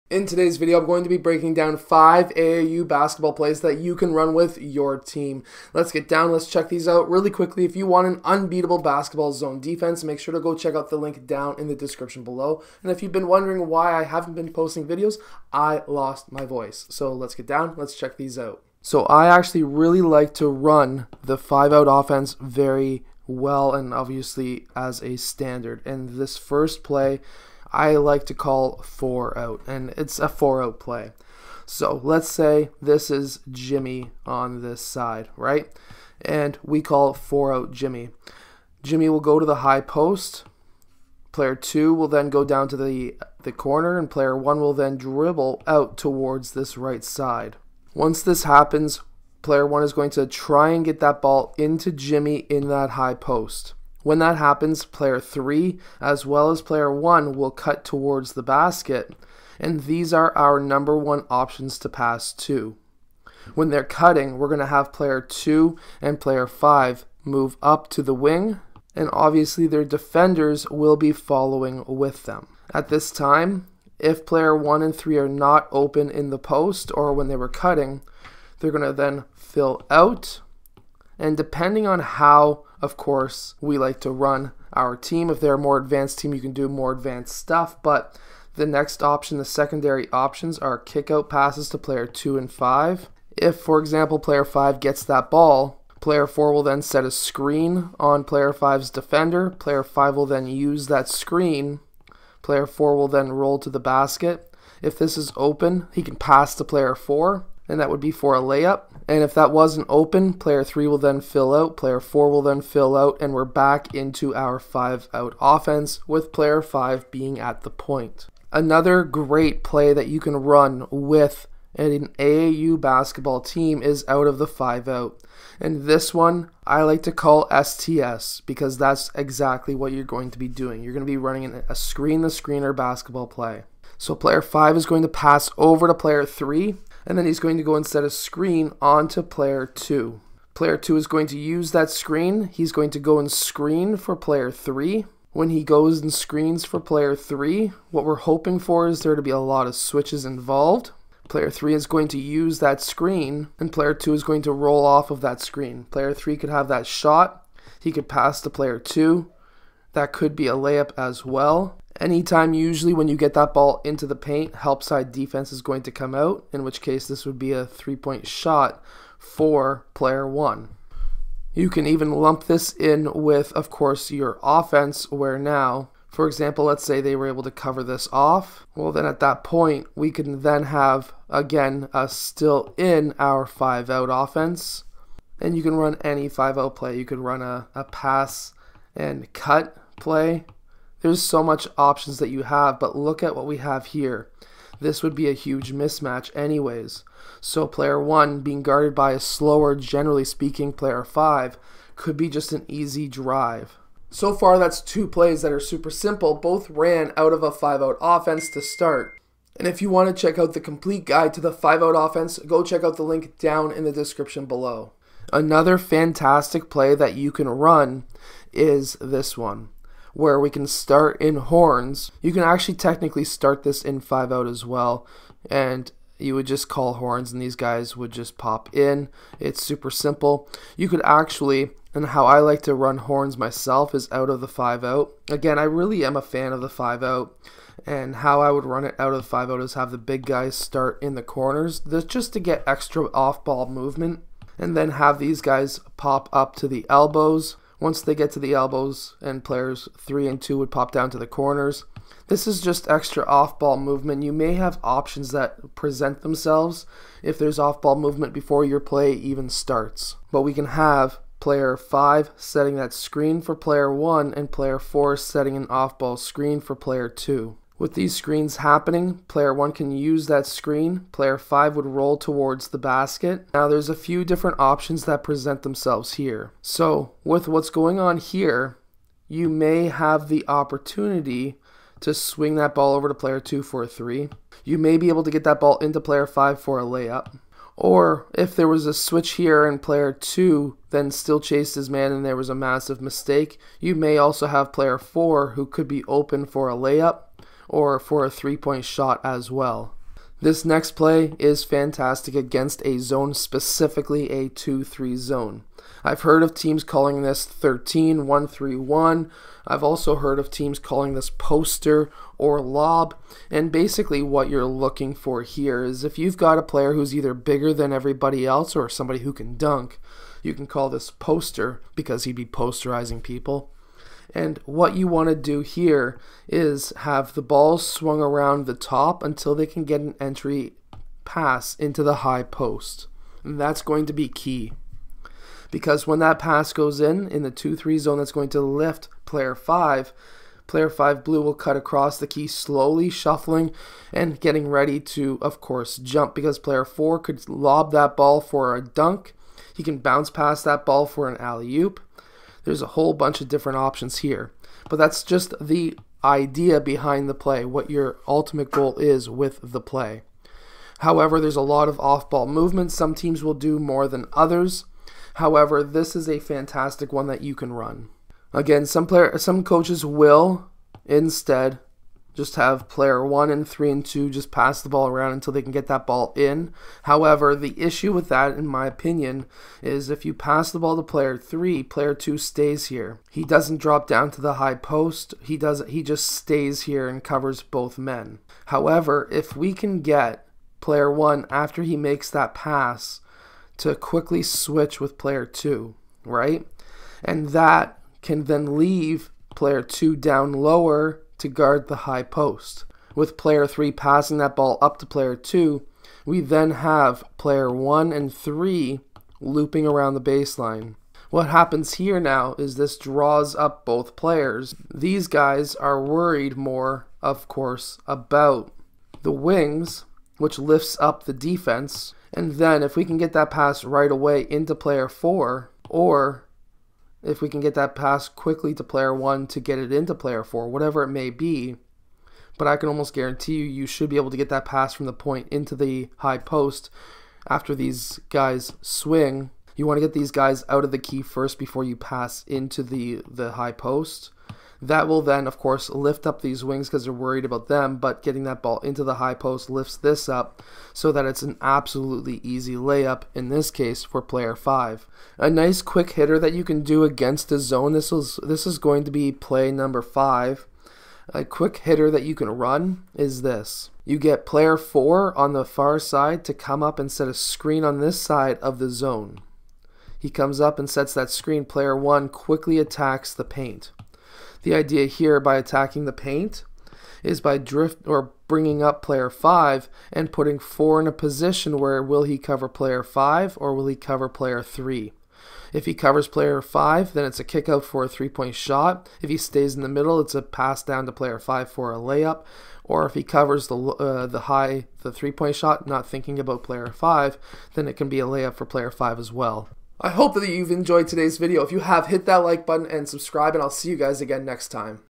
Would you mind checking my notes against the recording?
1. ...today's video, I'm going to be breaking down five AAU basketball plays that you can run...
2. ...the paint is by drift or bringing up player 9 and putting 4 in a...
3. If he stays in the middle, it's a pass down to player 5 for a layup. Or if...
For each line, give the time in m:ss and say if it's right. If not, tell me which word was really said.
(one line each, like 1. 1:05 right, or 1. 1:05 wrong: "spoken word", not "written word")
1. 0:00 right
2. 7:56 wrong: "5", not "9"
3. 8:09 right.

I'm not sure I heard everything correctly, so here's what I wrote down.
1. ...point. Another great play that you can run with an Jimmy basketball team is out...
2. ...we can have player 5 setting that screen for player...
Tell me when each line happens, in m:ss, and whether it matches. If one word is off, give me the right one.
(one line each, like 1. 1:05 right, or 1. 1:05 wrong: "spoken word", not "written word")
1. 1:57 wrong: "AAU", not "Jimmy"
2. 4:20 right.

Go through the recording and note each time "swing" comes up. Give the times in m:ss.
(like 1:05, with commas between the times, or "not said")
4:42, 7:18.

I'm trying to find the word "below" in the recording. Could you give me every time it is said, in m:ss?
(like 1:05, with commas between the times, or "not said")
0:12, 3:34.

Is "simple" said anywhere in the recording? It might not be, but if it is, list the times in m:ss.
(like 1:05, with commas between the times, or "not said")
3:25, 3:49.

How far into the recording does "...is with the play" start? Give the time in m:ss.
5:58.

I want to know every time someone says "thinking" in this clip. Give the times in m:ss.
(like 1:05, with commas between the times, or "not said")
8:16.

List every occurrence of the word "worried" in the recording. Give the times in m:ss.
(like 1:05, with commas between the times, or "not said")
6:56, 7:27.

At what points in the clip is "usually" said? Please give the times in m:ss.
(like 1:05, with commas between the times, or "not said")
2:42.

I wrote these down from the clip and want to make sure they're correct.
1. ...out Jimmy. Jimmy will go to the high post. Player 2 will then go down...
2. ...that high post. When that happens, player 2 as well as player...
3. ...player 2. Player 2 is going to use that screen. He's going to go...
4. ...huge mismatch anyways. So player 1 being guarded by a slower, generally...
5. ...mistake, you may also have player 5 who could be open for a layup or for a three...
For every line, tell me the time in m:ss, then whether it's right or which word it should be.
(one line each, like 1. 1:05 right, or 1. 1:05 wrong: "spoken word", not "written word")
1. 0:37 right
2. 0:52 wrong: "3", not "2"
3. 2:19 right
4. 3:15 right
5. 4:53 wrong: "4", not "5".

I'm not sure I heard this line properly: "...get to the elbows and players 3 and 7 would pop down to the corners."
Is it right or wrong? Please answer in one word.
wrong.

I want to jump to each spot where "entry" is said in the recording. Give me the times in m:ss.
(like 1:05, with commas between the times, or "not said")
5:30.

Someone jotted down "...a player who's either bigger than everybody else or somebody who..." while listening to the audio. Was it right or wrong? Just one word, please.
right.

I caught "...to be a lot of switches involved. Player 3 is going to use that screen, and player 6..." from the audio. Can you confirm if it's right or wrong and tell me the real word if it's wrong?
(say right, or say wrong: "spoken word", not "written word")
wrong: "2", not "6".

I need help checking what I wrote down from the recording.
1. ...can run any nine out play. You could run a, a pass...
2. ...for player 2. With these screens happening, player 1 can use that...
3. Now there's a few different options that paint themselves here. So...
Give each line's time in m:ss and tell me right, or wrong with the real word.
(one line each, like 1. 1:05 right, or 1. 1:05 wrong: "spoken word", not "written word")
1. 3:05 wrong: "five", not "nine"
2. 4:26 right
3. 4:33 wrong: "present", not "paint".